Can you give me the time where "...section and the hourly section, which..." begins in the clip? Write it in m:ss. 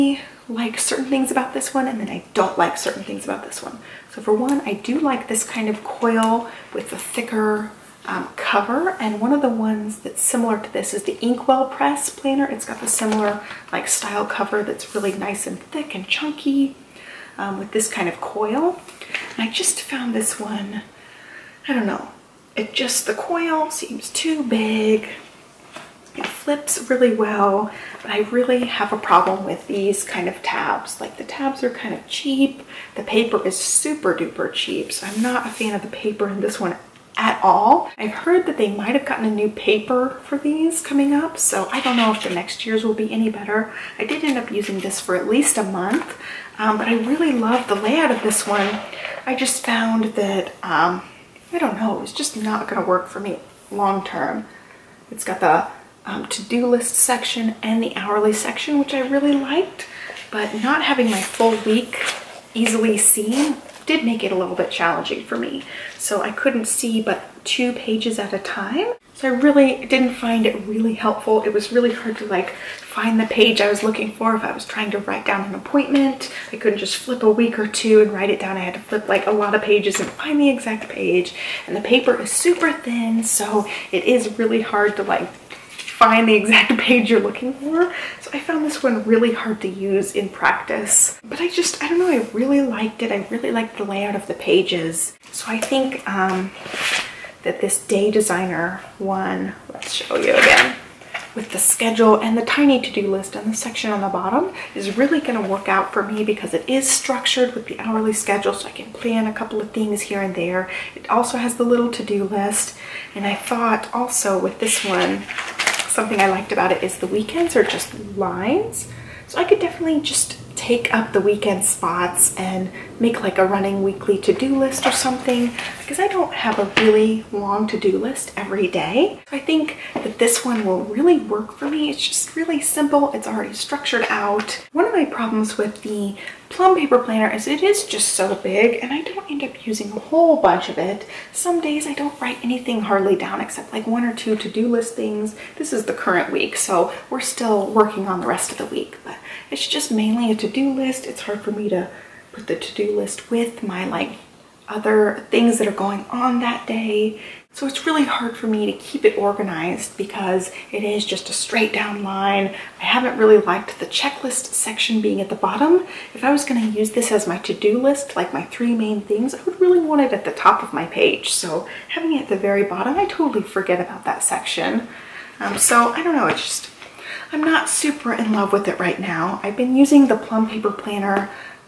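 0:56.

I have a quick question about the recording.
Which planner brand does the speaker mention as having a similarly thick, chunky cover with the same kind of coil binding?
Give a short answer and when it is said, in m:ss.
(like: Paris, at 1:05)
Inkwell Press, at 0:11.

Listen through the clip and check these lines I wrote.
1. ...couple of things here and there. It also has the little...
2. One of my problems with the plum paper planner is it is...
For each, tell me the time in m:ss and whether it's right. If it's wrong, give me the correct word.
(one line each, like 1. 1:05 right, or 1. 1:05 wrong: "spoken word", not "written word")
1. 1:49 right
2. 2:14 right.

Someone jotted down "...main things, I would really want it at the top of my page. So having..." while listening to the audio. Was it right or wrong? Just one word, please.
right.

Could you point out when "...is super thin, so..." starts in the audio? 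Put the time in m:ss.
1:22.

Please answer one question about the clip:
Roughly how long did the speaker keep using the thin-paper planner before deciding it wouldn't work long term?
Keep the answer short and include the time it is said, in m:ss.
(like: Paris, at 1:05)
a month, at 0:45.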